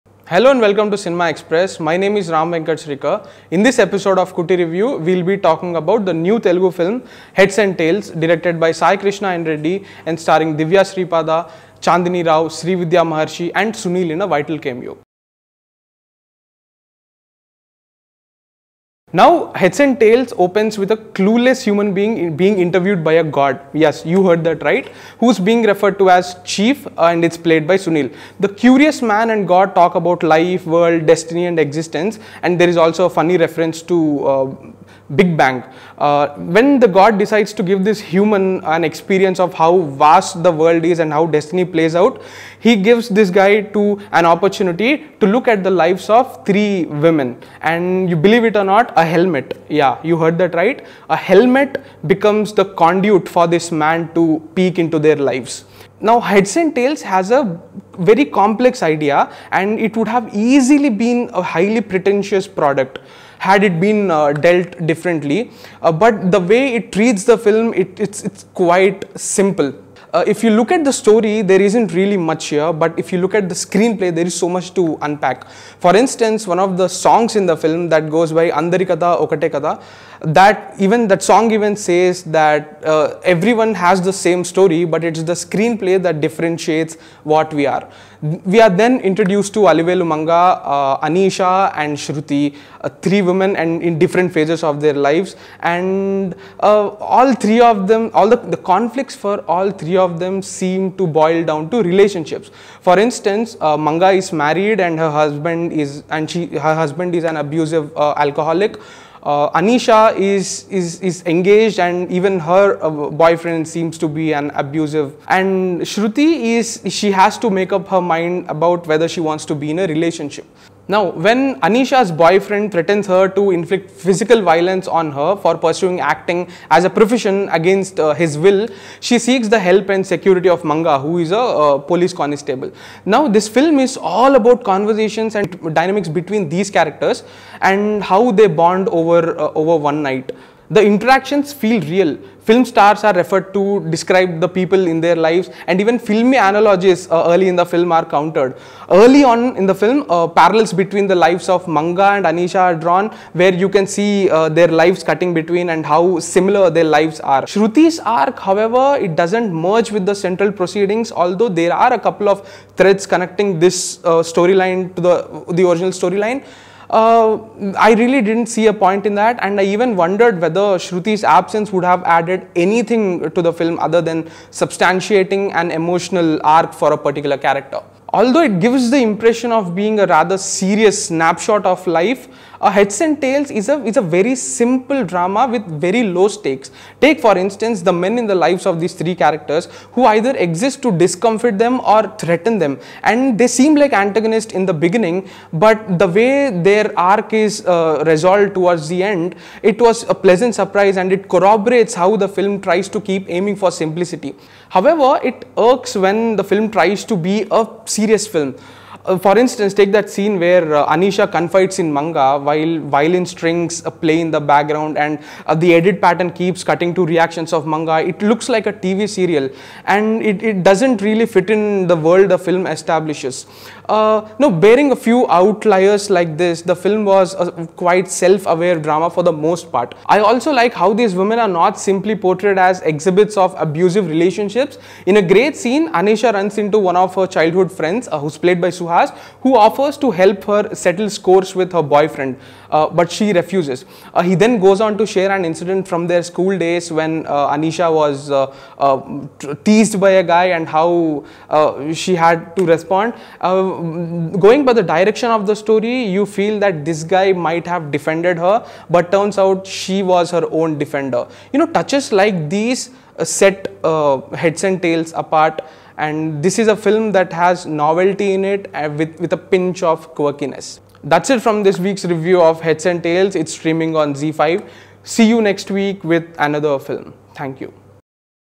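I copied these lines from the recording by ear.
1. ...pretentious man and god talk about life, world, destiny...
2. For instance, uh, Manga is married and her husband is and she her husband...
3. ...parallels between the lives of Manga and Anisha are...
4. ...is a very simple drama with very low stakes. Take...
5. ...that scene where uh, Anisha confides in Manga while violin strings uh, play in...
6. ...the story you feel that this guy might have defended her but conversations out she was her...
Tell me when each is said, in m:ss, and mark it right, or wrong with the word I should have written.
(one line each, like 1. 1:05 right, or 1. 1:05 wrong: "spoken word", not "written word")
1. 0:28 wrong: "curious", not "pretentious"
2. 1:42 right
3. 2:30 right
4. 3:03 right
5. 3:29 right
6. 4:15 wrong: "turns", not "conversations".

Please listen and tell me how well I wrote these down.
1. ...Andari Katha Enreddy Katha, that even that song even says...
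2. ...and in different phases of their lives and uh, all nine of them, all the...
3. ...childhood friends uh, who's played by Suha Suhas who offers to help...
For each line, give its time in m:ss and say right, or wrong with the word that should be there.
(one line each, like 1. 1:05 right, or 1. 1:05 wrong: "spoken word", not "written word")
1. 1:18 wrong: "Okate", not "Enreddy"
2. 1:33 wrong: "three", not "nine"
3. 3:57 right.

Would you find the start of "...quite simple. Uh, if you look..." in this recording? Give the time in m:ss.
1:08.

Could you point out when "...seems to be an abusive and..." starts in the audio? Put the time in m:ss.
1:53.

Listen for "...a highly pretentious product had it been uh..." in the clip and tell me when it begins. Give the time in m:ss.
1:01.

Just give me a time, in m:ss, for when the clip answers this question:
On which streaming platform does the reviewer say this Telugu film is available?
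4:34.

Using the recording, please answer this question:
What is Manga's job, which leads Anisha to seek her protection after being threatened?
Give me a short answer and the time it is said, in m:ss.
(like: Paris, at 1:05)
Police constable, at 2:11.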